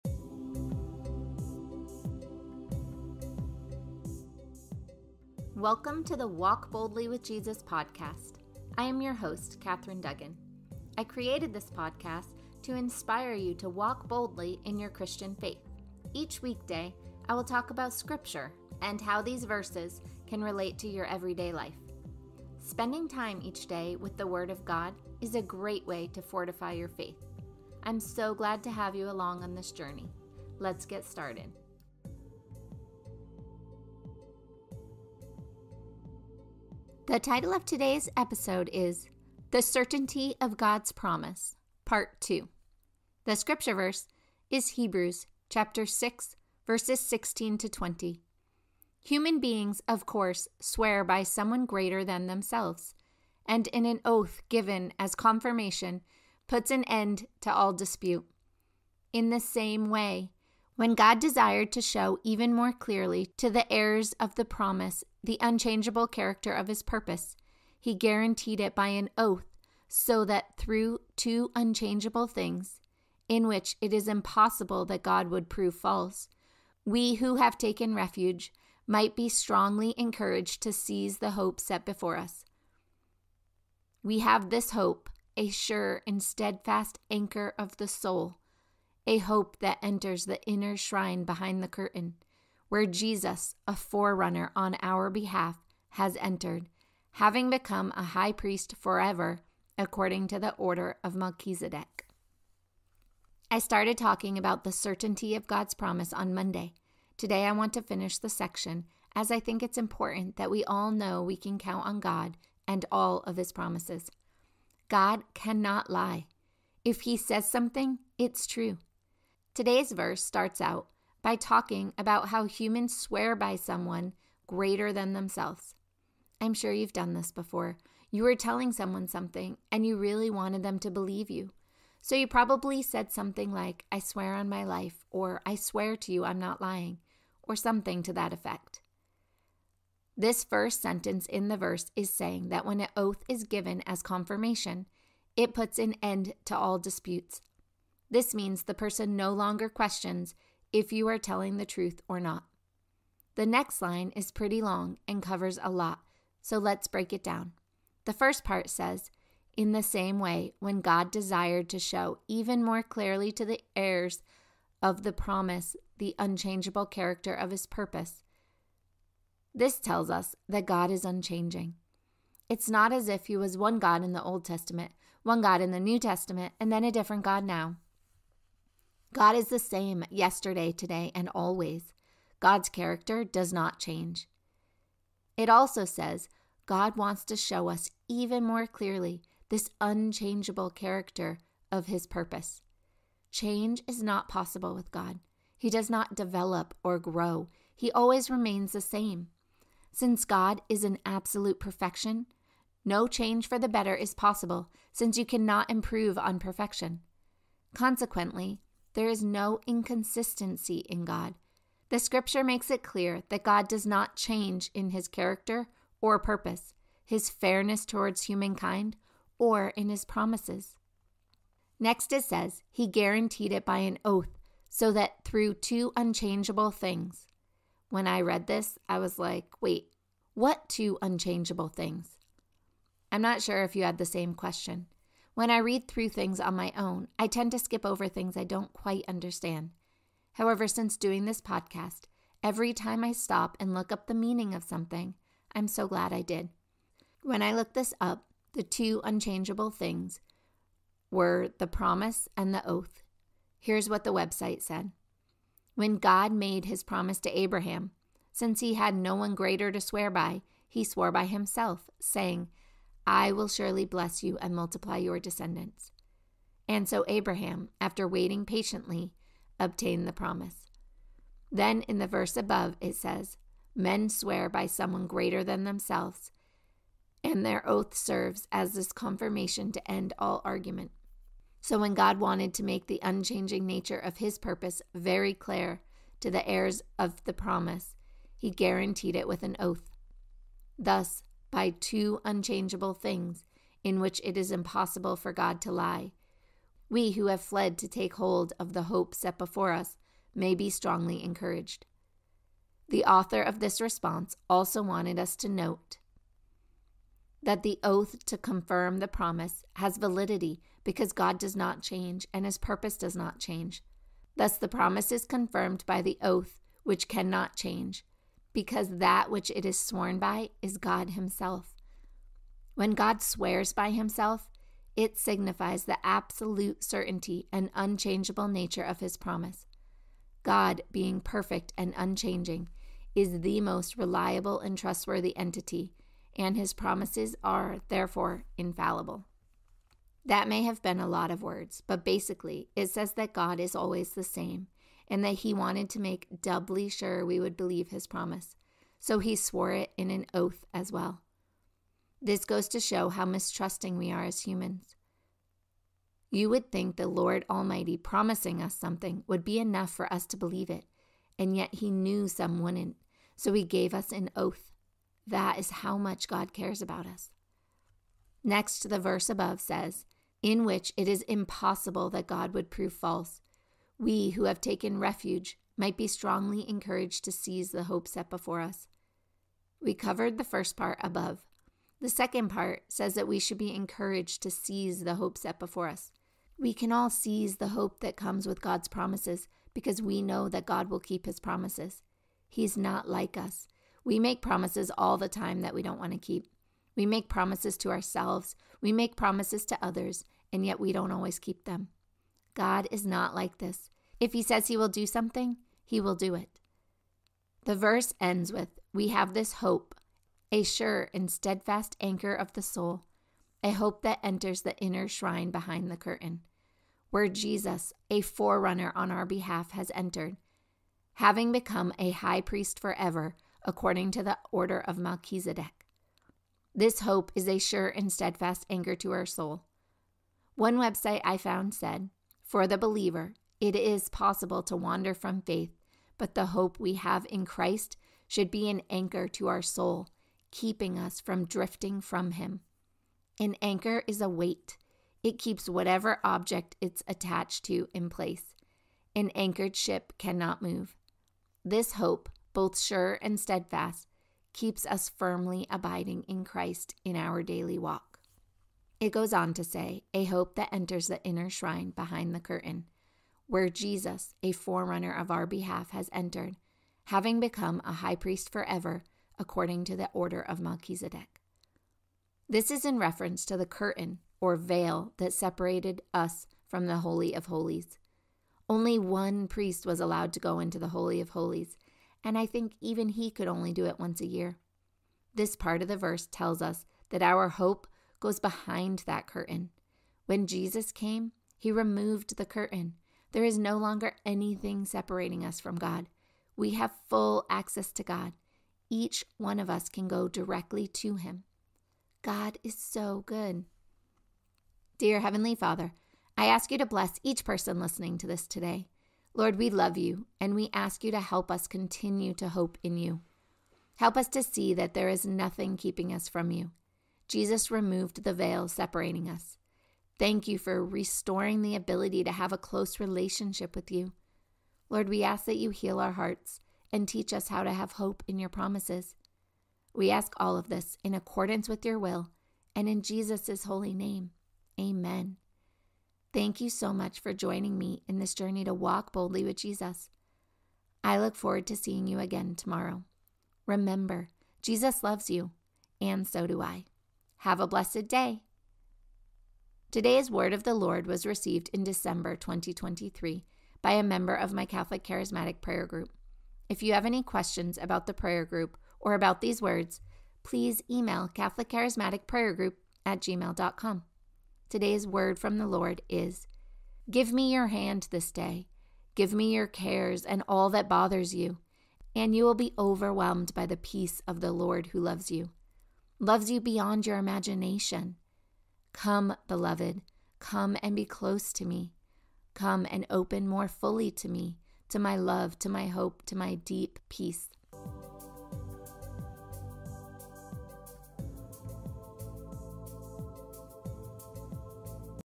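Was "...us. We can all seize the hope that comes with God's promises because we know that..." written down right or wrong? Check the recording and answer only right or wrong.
right.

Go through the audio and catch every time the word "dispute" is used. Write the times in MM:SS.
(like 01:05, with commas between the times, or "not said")
00:57, 02:26.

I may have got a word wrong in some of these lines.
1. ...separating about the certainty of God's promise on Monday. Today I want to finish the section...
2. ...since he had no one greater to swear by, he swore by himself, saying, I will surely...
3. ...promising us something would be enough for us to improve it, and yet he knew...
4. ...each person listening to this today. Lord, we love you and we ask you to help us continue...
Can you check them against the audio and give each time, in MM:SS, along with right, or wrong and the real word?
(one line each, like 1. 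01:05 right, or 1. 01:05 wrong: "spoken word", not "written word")
1. 01:43 wrong: "talking", not "separating"
2. 04:18 right
3. 05:57 wrong: "believe", not "improve"
4. 08:27 right.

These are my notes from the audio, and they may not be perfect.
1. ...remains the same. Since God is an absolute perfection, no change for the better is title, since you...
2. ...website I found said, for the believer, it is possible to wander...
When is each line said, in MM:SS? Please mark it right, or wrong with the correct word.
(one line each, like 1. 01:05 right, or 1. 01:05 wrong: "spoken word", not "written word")
1. 03:18 wrong: "possible", not "title"
2. 07:10 right.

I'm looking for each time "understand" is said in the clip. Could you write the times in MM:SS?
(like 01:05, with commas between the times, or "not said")
03:59.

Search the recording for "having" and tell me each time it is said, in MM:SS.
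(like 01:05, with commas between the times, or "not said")
01:37, 07:01, 07:47.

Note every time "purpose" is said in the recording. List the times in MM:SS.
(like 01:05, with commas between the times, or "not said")
01:06, 02:47, 03:12, 03:36, 04:44, 05:12.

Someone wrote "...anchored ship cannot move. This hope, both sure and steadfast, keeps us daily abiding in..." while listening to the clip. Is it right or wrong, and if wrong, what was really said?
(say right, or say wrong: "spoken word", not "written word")
wrong: "firmly", not "daily".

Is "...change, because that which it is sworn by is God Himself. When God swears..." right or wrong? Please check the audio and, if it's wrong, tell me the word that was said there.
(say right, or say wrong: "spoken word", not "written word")
right.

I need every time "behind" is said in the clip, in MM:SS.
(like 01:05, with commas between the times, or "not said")
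01:31, 06:55, 07:41, 08:08.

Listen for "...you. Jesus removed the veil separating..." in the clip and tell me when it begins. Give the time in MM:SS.
08:36.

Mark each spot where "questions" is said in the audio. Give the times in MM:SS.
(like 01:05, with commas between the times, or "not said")
02:29, 03:54, 09:17.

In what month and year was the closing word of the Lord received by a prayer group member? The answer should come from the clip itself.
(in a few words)
December 2023.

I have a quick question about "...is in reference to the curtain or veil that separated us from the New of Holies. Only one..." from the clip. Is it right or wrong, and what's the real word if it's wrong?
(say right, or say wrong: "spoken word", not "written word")
wrong: "Holy", not "New".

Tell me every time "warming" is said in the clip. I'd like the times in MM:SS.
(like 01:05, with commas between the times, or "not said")
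not said.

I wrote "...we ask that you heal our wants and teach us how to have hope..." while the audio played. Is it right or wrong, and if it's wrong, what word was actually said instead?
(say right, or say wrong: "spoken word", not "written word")
wrong: "hearts", not "wants".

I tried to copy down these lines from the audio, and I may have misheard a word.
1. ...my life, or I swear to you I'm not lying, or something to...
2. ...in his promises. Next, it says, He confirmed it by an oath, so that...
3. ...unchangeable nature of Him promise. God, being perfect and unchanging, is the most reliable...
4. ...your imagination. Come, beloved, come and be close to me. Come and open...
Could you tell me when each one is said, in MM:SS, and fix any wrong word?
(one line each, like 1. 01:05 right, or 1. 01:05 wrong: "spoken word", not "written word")
1. 02:14 right
2. 03:39 wrong: "guaranteed", not "confirmed"
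3. 05:27 wrong: "His", not "Him"
4. 09:37 right.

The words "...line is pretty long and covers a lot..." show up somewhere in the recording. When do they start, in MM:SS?
02:33.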